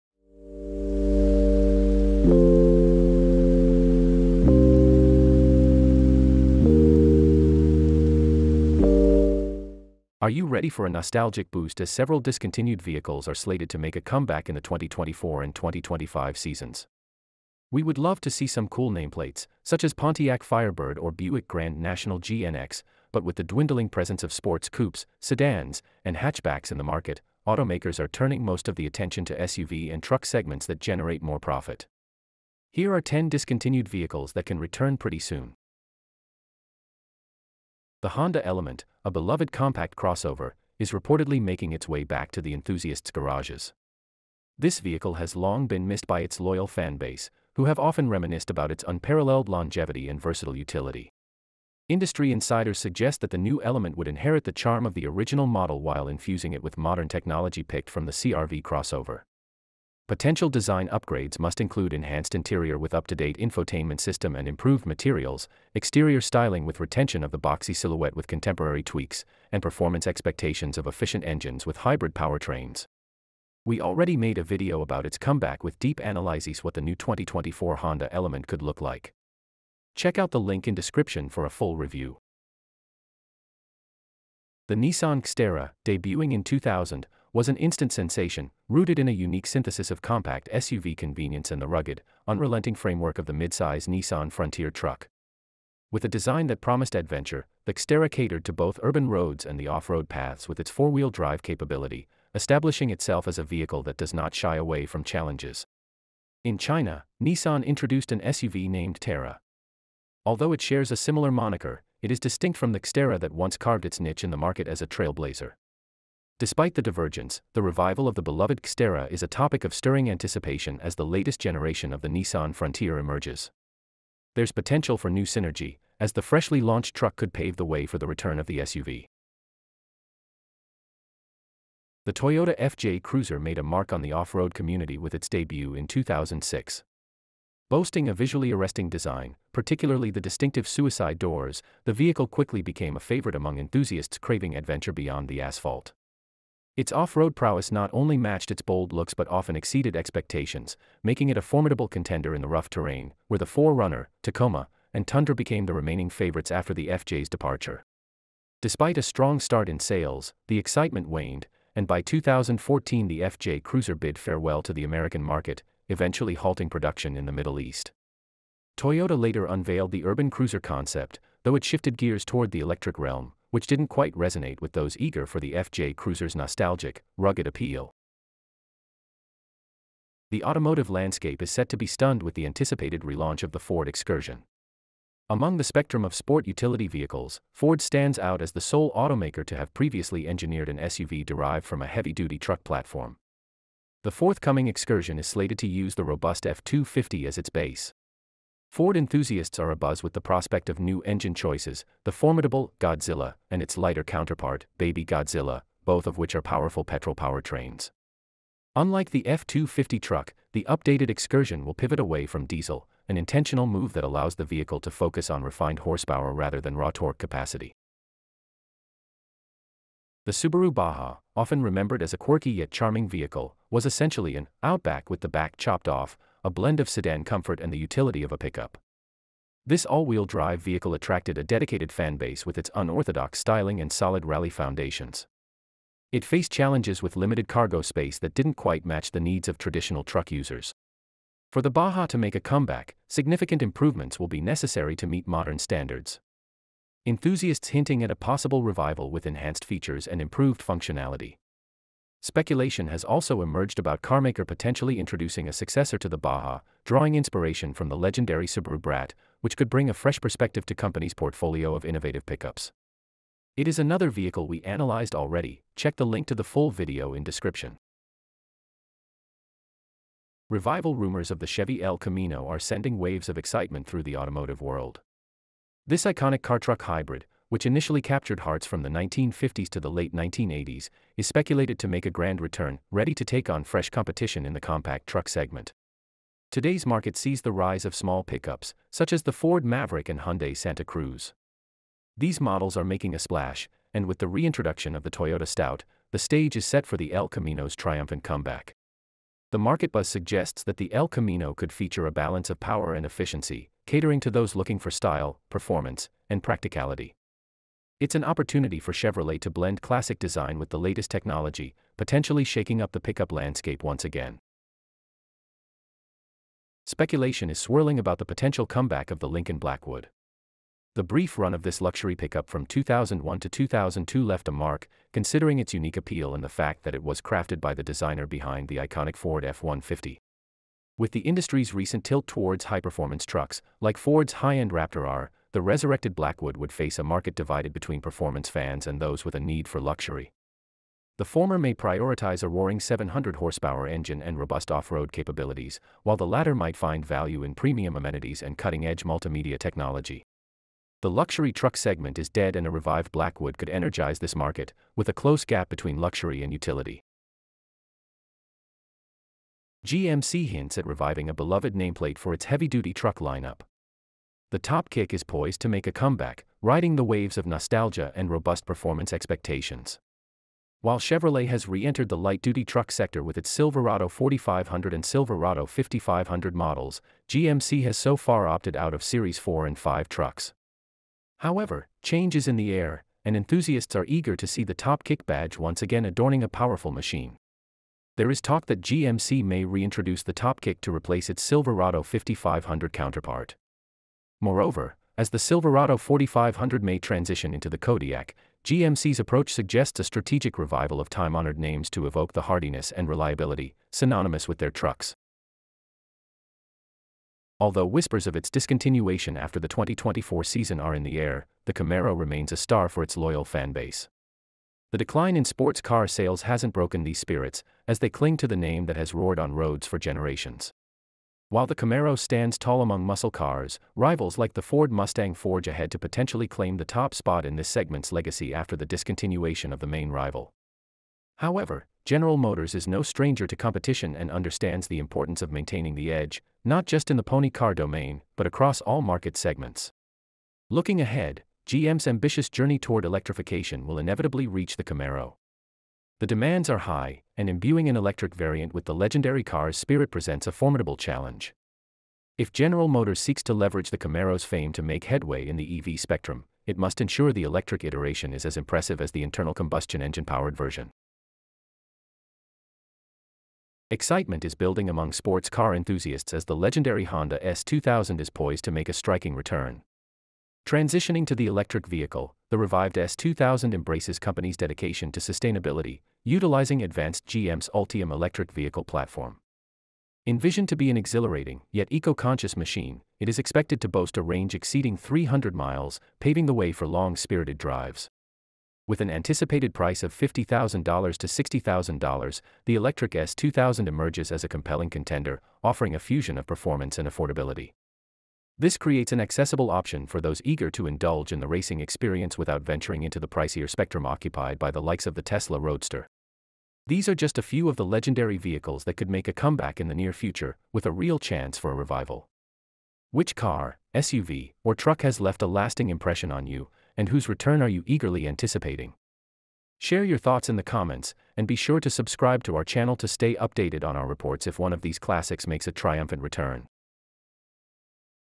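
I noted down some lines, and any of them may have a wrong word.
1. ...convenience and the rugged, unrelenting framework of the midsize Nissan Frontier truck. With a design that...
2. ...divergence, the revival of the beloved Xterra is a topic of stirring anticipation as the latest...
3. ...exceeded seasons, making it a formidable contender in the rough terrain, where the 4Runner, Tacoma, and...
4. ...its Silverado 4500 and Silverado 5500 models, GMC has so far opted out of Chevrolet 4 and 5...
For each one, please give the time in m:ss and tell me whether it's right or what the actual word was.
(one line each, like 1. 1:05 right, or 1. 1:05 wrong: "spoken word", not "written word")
1. 1:30 right
2. 1:56 right
3. 2:29 wrong: "expectations", not "seasons"
4. 6:13 wrong: "Series", not "Chevrolet".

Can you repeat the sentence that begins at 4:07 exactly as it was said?
Enthusiasts hinting at a possible revival with enhanced features and improved functionality.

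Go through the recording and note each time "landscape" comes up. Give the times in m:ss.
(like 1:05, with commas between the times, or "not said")
3:00, 5:13.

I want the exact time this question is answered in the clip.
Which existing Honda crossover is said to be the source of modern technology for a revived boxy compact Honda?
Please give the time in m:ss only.
0:58.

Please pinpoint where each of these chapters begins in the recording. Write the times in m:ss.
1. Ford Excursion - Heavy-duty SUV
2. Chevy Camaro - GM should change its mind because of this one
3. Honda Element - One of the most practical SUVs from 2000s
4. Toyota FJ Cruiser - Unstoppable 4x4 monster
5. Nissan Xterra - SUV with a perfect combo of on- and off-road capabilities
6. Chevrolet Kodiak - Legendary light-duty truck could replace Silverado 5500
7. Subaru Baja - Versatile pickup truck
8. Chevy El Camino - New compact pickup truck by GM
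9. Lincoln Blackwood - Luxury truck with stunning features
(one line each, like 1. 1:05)
1. 2:58
2. 6:45
3. 0:35
4. 2:09
5. 1:22
6. 5:58
7. 3:38
8. 4:28
9. 5:14.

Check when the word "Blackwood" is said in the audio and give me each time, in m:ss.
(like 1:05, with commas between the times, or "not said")
5:19, 5:36, 5:53.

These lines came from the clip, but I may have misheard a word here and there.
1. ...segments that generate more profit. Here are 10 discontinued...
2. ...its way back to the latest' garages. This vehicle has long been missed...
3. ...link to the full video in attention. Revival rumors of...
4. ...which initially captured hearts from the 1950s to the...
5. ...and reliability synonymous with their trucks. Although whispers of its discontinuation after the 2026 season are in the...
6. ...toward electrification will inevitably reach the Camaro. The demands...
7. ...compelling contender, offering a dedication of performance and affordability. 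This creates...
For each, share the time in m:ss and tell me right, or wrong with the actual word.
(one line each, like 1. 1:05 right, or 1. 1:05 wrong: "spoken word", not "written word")
1. 0:30 right
2. 0:41 wrong: "enthusiasts", not "latest"
3. 4:26 wrong: "description", not "attention"
4. 4:37 right
5. 6:42 wrong: "2024", not "2026"
6. 7:22 right
7. 8:14 wrong: "fusion", not "dedication".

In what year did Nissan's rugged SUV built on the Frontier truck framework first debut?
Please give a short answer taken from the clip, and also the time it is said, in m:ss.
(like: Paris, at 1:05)
2000, at 1:26.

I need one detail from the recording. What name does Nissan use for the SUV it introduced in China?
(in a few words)
Terra.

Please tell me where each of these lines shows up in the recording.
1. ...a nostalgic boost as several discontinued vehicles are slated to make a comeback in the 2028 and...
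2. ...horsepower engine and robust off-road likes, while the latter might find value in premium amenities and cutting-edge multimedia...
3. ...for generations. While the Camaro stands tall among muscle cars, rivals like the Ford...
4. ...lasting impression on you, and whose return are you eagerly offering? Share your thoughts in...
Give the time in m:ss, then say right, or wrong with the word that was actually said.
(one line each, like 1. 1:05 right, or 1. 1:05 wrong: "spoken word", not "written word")
1. 0:10 wrong: "2024", not "2028"
2. 5:43 wrong: "capabilities", not "likes"
3. 6:59 right
4. 8:35 wrong: "anticipating", not "offering".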